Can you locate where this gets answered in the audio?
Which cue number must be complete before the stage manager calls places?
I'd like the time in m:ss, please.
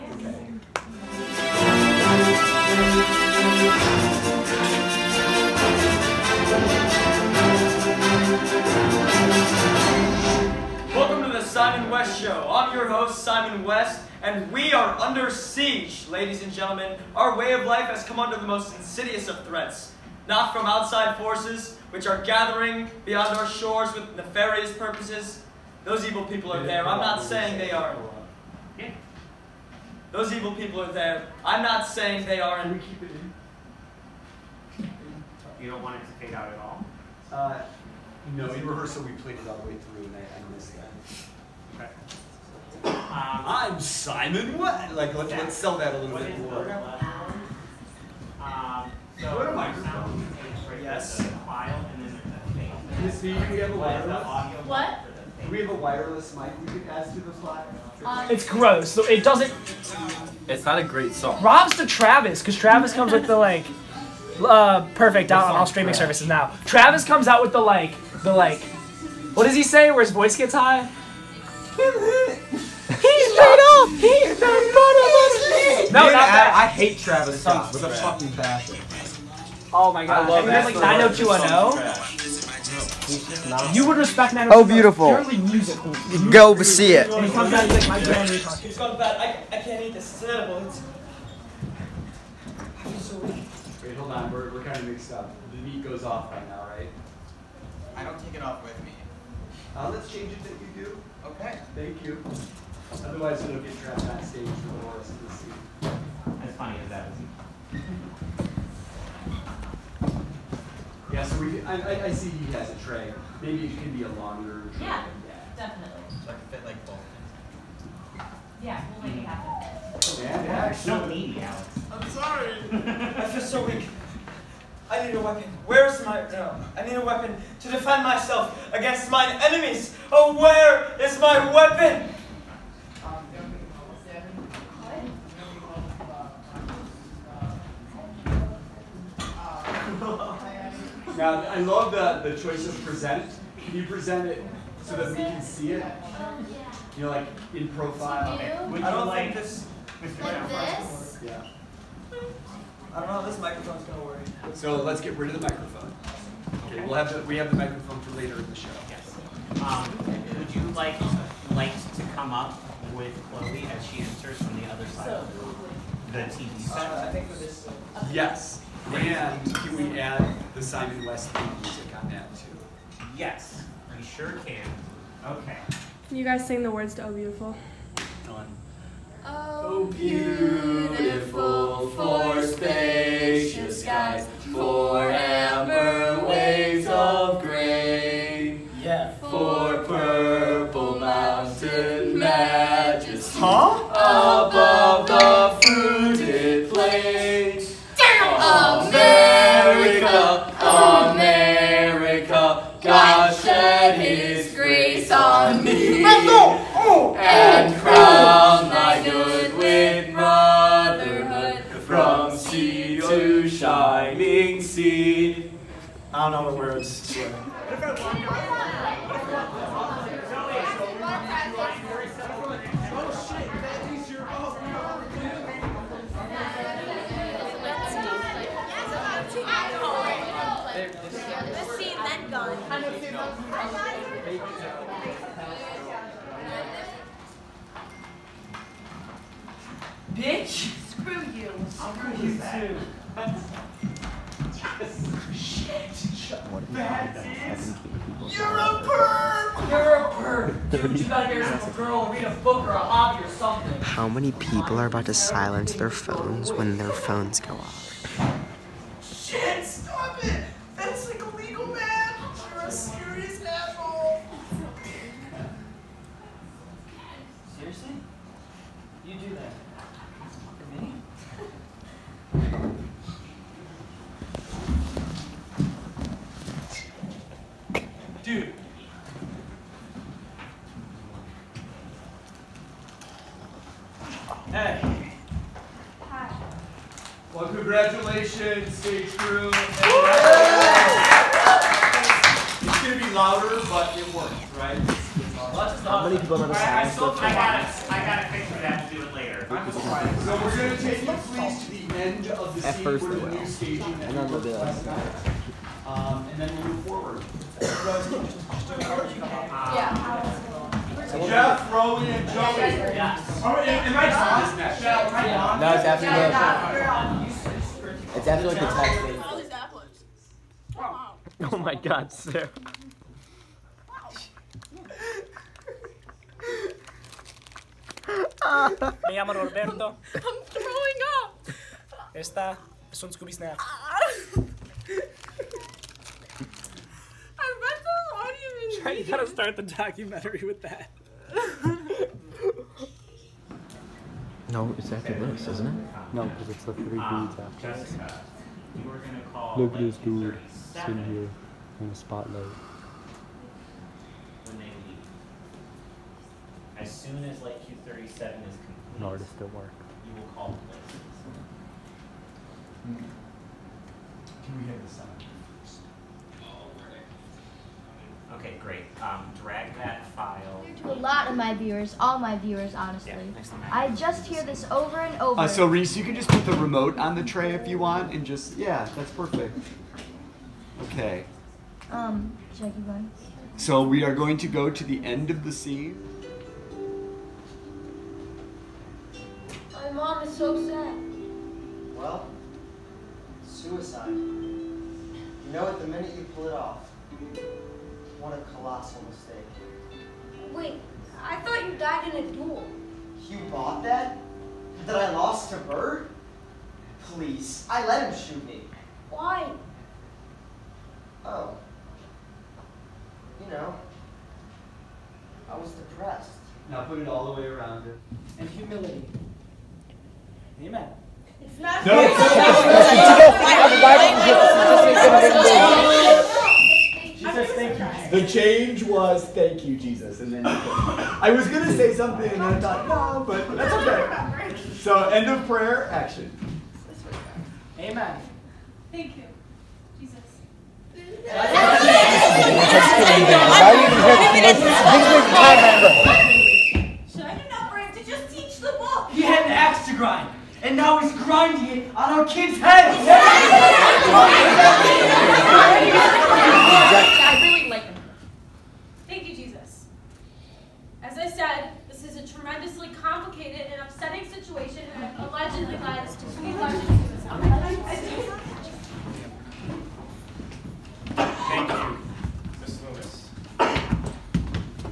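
5:57.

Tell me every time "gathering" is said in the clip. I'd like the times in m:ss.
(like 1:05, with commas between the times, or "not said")
0:22.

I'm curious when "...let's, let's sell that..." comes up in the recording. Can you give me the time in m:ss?
0:45.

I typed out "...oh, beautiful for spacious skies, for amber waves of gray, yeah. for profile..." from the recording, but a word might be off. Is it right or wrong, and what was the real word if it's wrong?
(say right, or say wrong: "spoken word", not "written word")
wrong: "purple", not "profile".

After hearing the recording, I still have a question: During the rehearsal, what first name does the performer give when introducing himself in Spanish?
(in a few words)
Roberto.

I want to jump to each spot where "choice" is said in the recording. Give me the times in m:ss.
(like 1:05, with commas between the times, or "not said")
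2:22.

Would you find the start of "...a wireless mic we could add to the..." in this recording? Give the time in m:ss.
0:55.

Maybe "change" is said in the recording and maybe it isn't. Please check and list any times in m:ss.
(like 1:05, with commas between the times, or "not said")
1:40, 7:08.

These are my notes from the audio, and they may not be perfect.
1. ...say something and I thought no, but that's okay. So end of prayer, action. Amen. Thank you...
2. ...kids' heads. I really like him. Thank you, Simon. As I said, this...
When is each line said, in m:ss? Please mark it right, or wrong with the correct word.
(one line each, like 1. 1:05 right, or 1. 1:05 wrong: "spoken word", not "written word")
1. 7:11 right
2. 7:32 wrong: "Jesus", not "Simon".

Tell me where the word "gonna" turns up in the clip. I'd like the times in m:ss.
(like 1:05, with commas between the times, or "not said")
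2:33, 7:11.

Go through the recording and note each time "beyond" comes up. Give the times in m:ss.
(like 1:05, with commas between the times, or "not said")
0:23.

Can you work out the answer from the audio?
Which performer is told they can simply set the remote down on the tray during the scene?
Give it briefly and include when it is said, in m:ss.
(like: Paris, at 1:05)
Reese, at 6:15.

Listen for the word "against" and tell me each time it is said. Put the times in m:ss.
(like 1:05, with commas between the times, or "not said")
2:08.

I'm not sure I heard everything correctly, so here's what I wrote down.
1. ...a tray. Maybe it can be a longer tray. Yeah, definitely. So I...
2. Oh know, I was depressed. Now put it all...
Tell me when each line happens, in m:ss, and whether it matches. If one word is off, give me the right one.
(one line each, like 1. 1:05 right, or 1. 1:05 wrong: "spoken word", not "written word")
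1. 1:52 right
2. 6:51 right.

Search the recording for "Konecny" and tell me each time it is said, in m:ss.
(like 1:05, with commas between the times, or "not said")
not said.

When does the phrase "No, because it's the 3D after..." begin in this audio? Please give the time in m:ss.
5:46.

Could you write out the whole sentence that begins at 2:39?
Um, would you like like to come up with Chloe as she enters from the other side of the, the TV set?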